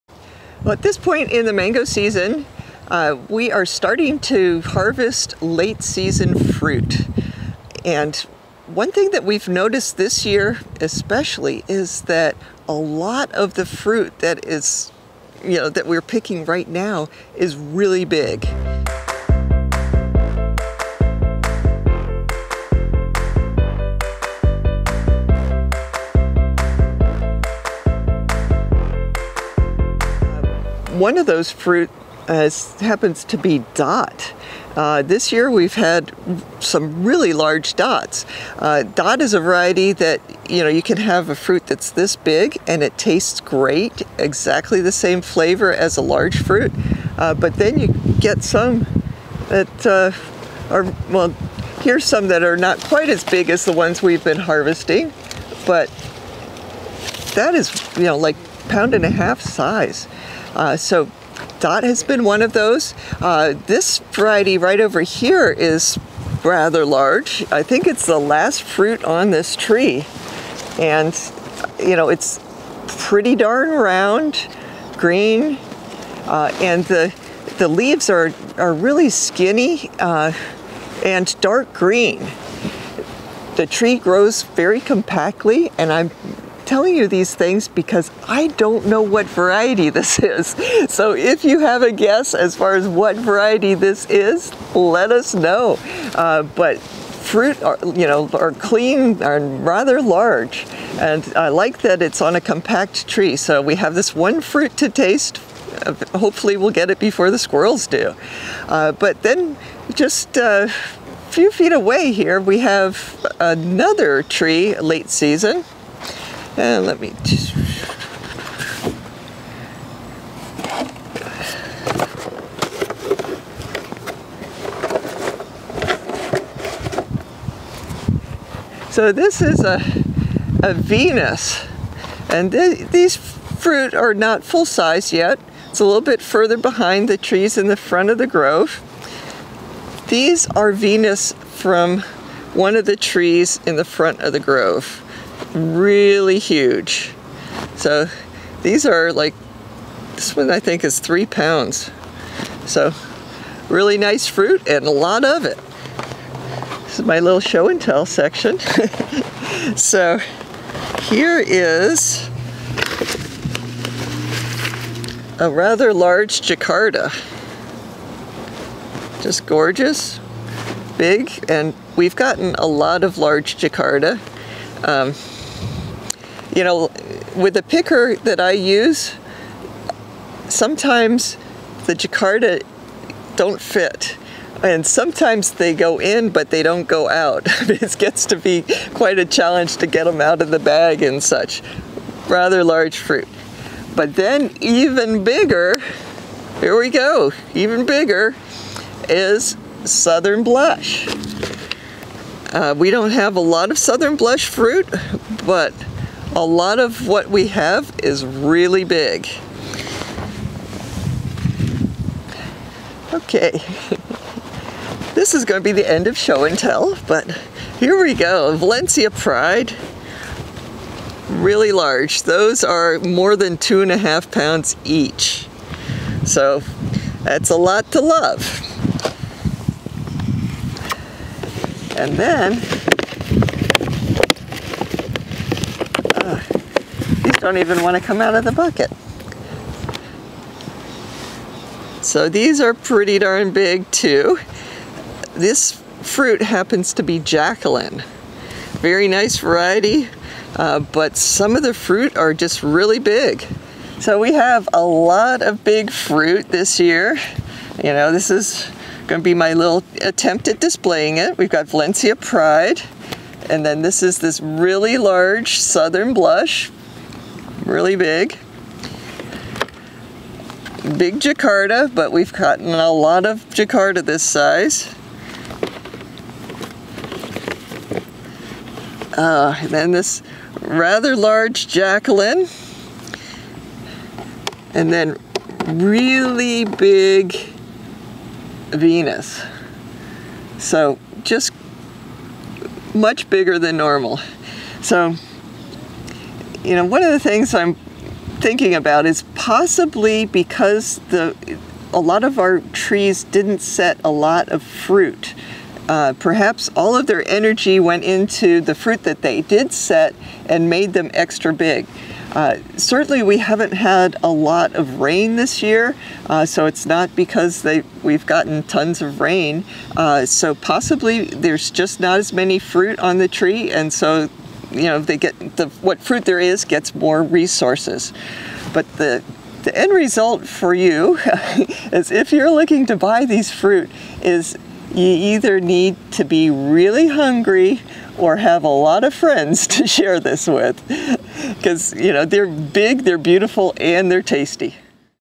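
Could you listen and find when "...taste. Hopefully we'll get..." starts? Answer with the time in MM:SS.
01:44.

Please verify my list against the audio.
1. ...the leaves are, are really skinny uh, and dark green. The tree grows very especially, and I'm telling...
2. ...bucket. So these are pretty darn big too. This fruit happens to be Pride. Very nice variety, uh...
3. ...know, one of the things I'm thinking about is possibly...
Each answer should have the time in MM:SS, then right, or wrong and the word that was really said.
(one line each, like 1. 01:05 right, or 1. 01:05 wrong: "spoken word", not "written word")
1. 01:17 wrong: "compactly", not "especially"
2. 03:58 wrong: "Jacqueline", not "Pride"
3. 04:56 right.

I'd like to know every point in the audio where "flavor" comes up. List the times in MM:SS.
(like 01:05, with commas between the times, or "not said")
00:45.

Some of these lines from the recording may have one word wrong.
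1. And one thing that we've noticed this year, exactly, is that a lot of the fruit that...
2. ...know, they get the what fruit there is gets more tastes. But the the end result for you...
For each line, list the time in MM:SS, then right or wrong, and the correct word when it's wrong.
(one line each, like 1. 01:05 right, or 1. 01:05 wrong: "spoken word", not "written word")
1. 00:07 wrong: "especially", not "exactly"
2. 05:24 wrong: "resources", not "tastes".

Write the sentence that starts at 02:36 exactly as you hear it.
This is my little show and tell section.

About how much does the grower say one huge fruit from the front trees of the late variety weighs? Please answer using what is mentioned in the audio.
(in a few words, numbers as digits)
3 pounds.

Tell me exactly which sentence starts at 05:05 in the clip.
Uh, perhaps all of their energy went into the fruit that they did set and made them extra big.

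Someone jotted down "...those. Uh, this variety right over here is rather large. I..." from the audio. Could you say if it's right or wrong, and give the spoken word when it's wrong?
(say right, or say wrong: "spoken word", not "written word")
right.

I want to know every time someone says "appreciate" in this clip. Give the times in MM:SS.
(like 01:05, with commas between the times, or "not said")
not said.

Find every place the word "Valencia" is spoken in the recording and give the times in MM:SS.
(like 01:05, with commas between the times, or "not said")
03:38, 04:21.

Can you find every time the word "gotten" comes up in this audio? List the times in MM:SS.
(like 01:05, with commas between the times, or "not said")
02:52, 04:32, 05:18.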